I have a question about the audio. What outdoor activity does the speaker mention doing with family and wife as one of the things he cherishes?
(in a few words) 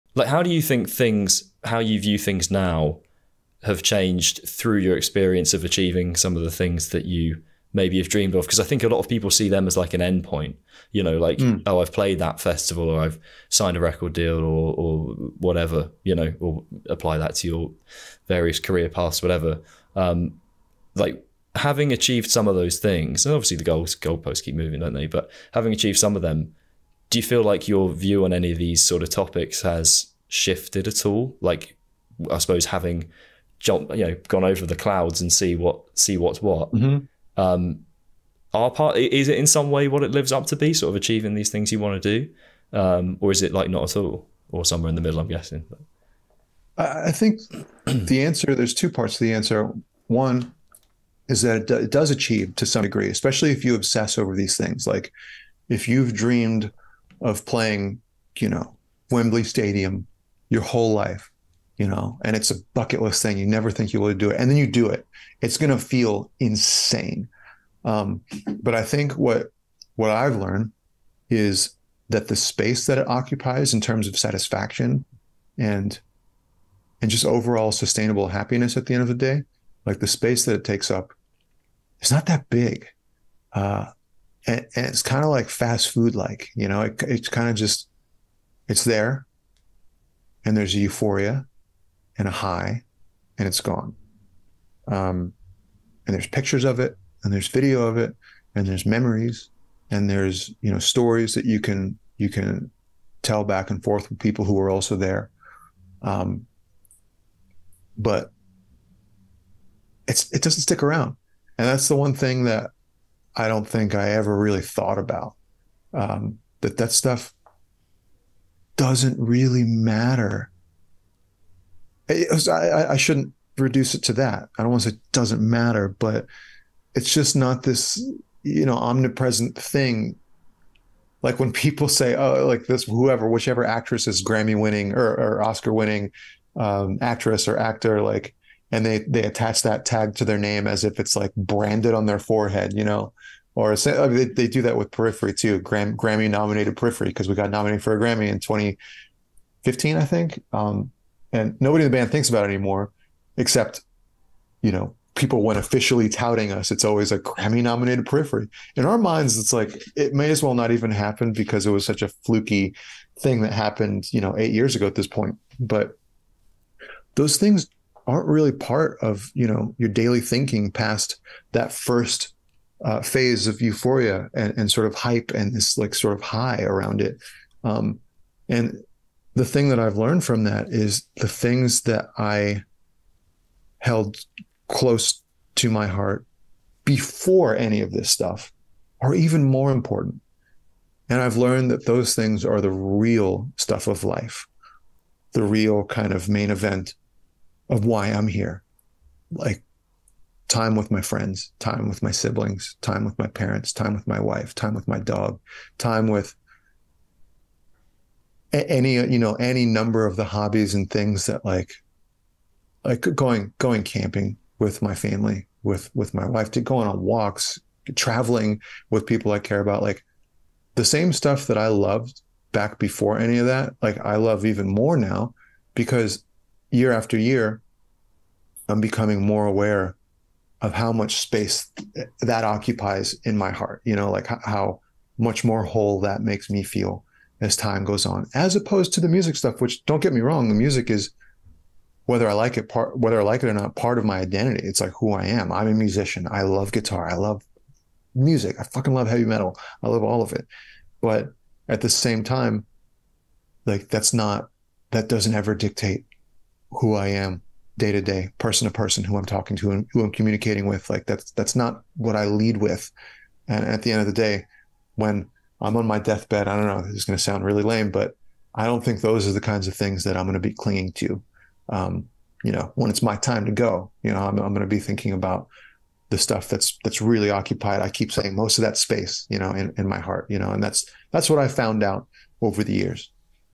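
Camping.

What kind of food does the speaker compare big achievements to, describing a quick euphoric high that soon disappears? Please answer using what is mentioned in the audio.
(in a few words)
Fast food.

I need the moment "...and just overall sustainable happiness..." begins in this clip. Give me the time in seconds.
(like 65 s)
77 s.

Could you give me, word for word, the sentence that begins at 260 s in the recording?
Like that's that's not what I lead with.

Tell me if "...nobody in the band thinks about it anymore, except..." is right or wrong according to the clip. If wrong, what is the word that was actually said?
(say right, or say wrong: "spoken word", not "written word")
right.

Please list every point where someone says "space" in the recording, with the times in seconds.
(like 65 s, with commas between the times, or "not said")
72 s, 80 s, 231 s, 278 s.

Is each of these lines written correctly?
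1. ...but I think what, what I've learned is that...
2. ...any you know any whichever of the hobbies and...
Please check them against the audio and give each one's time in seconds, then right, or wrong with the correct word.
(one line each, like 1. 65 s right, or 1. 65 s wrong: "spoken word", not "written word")
1. 68 s right
2. 208 s wrong: "number", not "whichever".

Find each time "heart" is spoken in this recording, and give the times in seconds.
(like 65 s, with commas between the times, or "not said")
185 s, 233 s, 279 s.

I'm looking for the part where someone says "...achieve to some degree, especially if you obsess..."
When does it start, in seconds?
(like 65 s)
52 s.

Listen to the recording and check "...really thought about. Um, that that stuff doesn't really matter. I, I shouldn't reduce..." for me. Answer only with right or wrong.
right.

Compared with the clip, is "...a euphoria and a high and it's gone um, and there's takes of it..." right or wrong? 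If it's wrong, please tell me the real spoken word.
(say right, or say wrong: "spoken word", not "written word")
wrong: "pictures", not "takes".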